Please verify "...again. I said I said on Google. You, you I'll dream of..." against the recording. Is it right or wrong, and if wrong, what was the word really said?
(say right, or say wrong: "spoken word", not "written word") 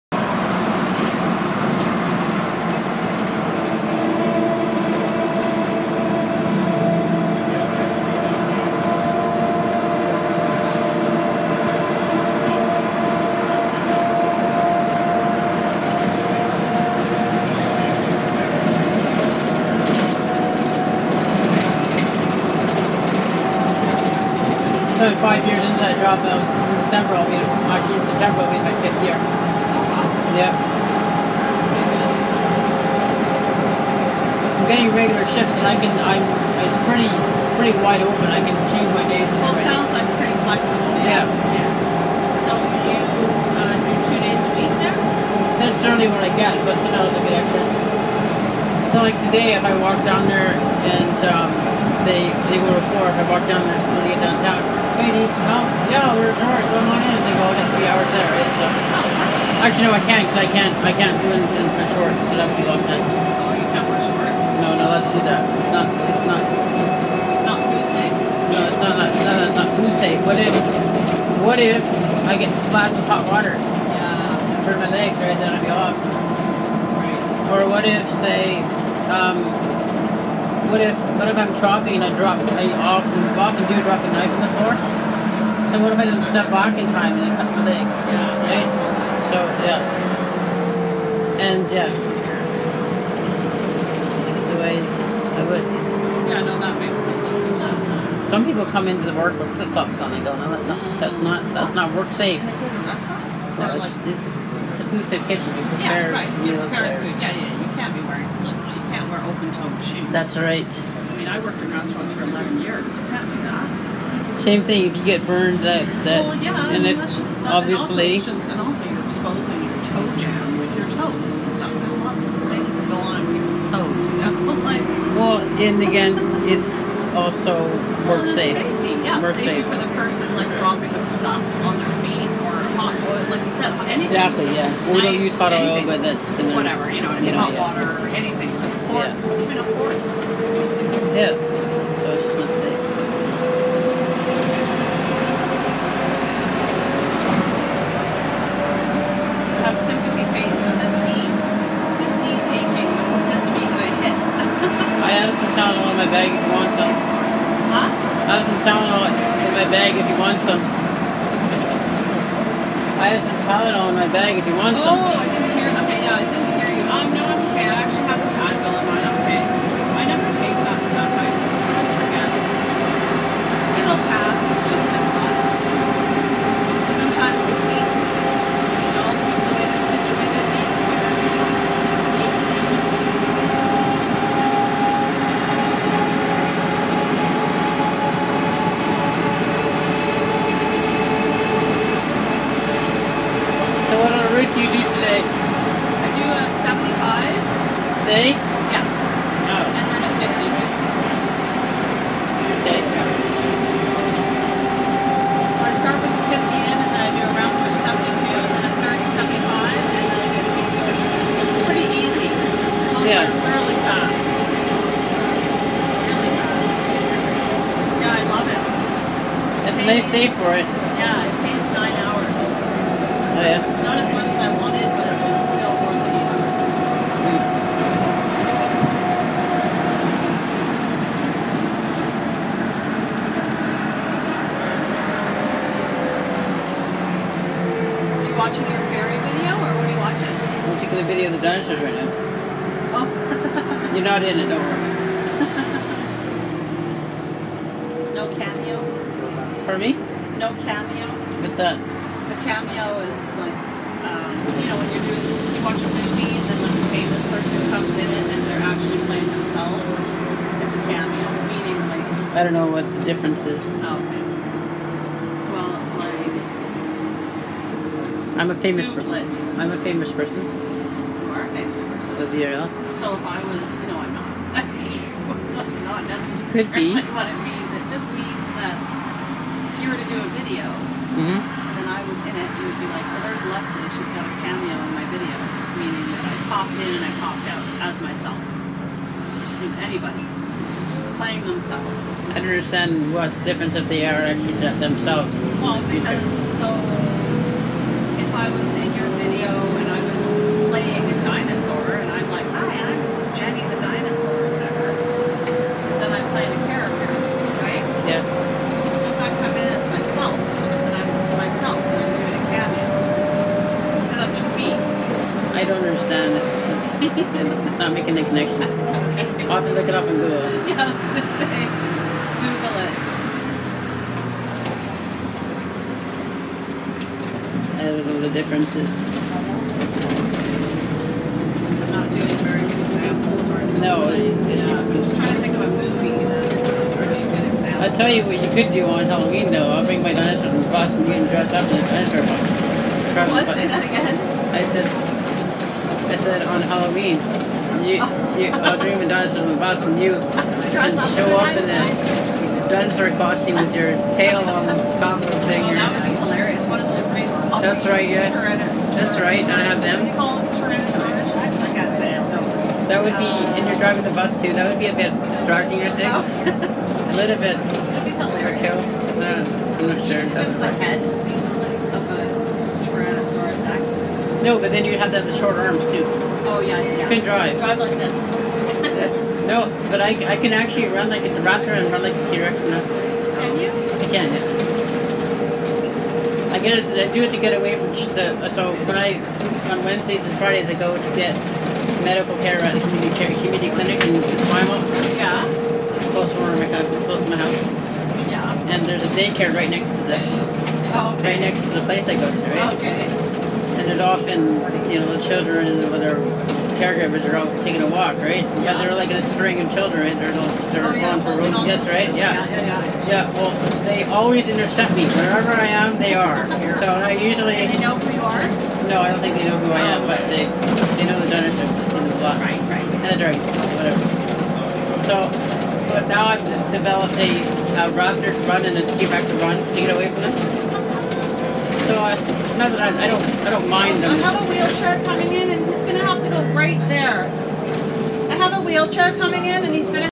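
wrong: "Halloween", not "Google".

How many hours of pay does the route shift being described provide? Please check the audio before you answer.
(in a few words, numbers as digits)
9 hours.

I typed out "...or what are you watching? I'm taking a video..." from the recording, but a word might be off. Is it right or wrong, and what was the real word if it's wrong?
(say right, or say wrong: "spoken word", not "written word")
right.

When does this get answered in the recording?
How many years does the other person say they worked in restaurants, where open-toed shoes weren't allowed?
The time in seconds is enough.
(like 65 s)
112 s.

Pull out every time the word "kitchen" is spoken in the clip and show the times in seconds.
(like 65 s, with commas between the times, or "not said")
105 s.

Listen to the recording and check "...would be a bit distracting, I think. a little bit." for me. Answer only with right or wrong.
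right.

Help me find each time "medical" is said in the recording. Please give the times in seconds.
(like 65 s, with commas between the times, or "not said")
392 s.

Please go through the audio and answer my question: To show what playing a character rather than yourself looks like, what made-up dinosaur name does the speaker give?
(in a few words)
Jenny the dinosaur.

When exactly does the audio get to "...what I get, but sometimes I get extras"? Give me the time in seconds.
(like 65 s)
46 s.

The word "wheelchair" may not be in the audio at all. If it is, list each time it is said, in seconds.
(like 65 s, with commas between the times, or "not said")
434 s, 438 s.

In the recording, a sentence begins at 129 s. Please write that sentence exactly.
for the person like dropping stuff on their feet or hot oil, like you said, anything.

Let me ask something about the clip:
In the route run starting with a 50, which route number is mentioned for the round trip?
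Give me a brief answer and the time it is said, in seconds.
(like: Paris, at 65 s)
72, at 207 s.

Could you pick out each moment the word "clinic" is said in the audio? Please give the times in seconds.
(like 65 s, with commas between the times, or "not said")
393 s.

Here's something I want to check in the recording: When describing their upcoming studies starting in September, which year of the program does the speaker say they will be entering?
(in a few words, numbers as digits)
fifth year.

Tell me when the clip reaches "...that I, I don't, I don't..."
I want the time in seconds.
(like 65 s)
432 s.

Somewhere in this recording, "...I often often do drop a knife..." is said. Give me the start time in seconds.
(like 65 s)
82 s.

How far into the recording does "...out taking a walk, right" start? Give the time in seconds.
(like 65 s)
407 s.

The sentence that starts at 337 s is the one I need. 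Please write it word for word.
I'll tell you what you could do on Halloween though.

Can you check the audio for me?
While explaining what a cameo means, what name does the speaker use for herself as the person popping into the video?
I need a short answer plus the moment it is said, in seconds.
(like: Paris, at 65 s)
Leslie, at 283 s.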